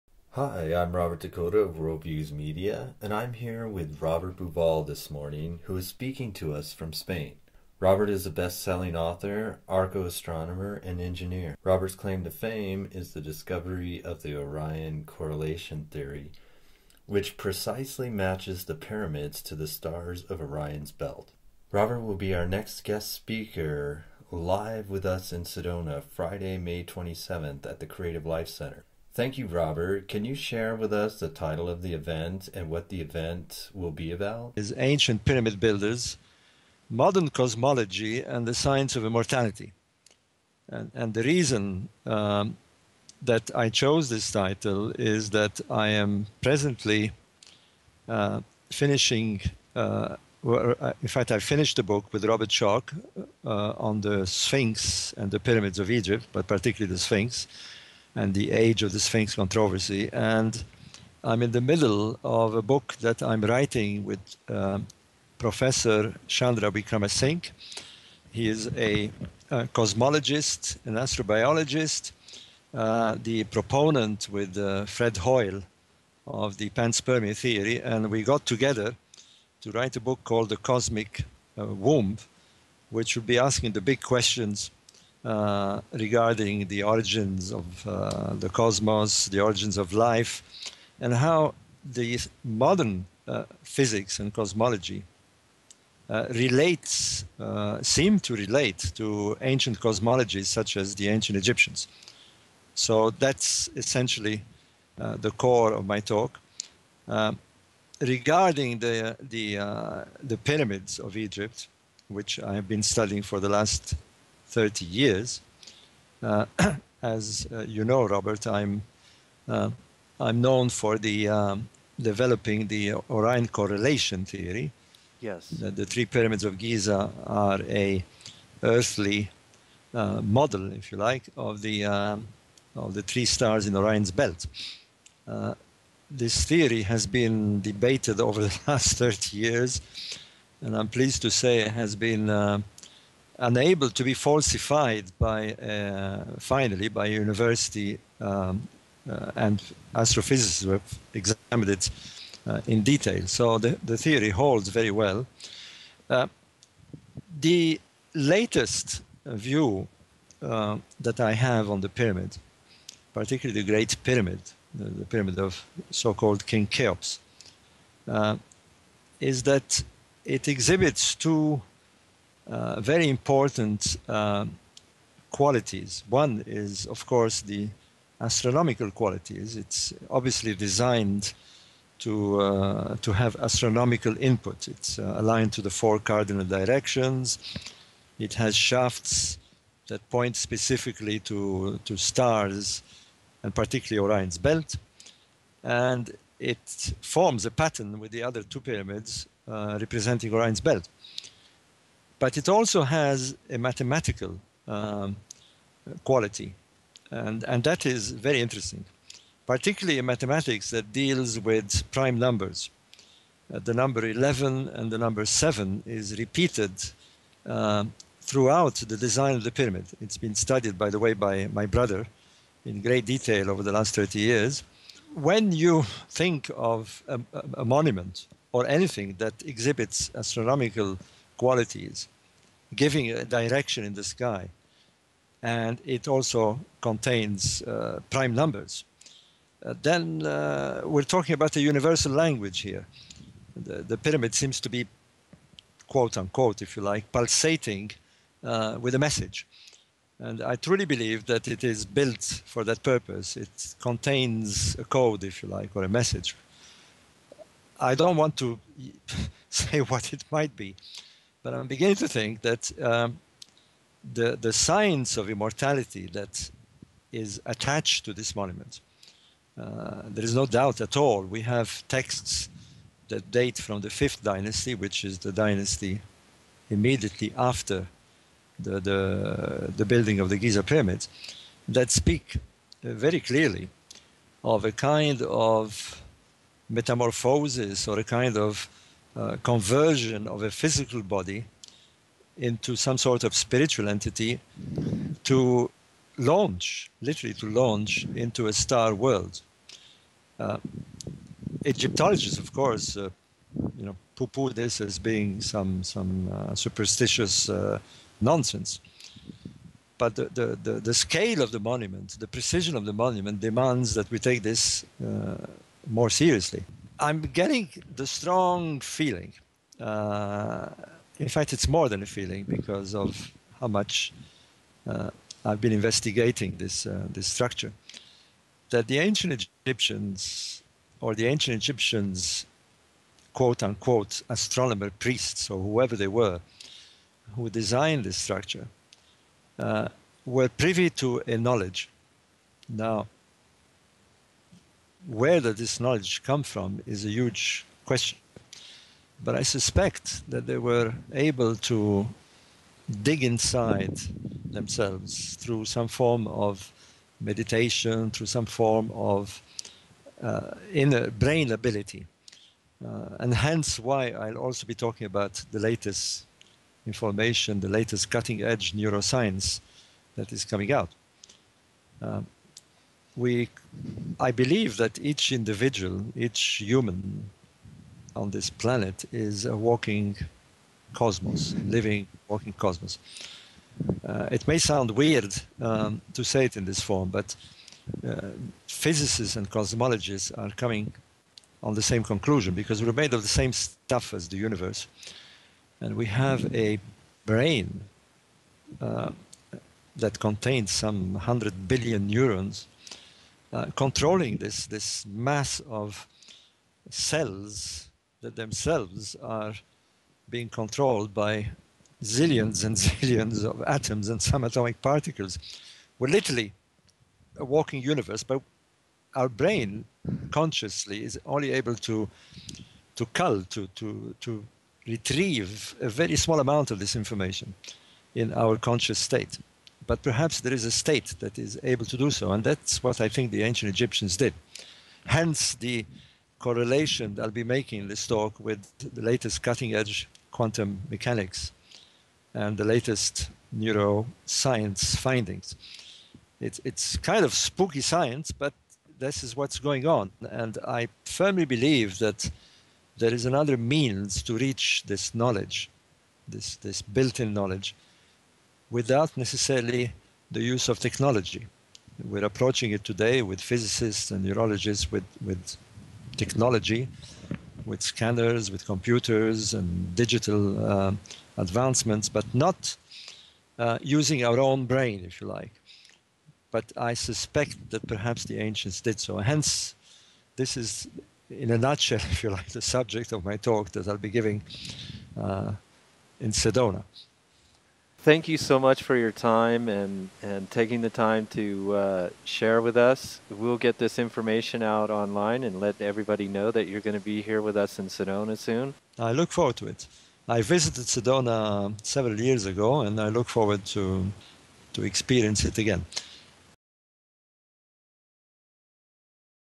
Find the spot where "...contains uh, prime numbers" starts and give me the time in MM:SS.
03:56.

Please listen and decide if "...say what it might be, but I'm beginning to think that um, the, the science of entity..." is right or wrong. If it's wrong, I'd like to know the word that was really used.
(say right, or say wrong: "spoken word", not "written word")
wrong: "immortality", not "entity".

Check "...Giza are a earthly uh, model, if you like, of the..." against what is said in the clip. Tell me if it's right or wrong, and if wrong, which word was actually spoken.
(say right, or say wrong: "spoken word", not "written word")
right.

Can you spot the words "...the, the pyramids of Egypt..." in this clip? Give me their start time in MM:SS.
01:49.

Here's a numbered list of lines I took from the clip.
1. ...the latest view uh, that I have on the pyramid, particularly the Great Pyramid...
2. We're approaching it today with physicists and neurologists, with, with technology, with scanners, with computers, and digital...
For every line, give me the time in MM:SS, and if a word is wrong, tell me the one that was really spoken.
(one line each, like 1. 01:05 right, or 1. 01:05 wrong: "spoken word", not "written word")
1. 02:37 right
2. 07:42 right.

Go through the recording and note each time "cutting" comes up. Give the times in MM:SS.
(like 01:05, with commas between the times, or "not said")
06:08, 07:19.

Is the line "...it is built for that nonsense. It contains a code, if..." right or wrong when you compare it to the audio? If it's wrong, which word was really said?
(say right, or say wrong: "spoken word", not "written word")
wrong: "purpose", not "nonsense".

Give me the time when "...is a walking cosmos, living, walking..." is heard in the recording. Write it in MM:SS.
06:19.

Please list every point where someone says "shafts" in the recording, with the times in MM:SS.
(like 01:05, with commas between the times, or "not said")
03:08.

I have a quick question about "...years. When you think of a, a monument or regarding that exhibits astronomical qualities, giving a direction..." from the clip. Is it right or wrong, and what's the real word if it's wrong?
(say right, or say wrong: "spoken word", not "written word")
wrong: "anything", not "regarding".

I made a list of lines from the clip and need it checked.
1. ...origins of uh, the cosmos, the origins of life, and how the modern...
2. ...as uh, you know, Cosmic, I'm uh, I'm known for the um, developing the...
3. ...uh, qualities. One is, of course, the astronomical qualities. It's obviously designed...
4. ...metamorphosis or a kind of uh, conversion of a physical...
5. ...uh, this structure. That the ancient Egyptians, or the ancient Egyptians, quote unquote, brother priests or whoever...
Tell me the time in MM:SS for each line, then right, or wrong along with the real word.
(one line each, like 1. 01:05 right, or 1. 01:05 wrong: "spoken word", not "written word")
1. 01:26 right
2. 01:57 wrong: "Robert", not "Cosmic"
3. 02:54 right
4. 04:46 right
5. 05:26 wrong: "astronomer", not "brother".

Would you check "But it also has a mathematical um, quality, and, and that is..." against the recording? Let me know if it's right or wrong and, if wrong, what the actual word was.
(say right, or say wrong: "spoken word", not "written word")
right.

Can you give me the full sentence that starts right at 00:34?
Is Ancient Pyramid Builders, Modern Cosmology and the Science of Immortality.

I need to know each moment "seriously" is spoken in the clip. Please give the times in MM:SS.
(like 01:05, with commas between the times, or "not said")
05:16.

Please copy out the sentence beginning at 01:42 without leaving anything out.
So that's essentially the core of my talk.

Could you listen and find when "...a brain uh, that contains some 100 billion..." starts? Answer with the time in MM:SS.
06:36.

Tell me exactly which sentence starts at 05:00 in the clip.
Uh, Egyptologists, of course, uh, you know, poo-poo this as being some some uh, superstitious uh, nonsense.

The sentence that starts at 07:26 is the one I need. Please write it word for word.
It's, it's kind of spooky science, but this is what's going on.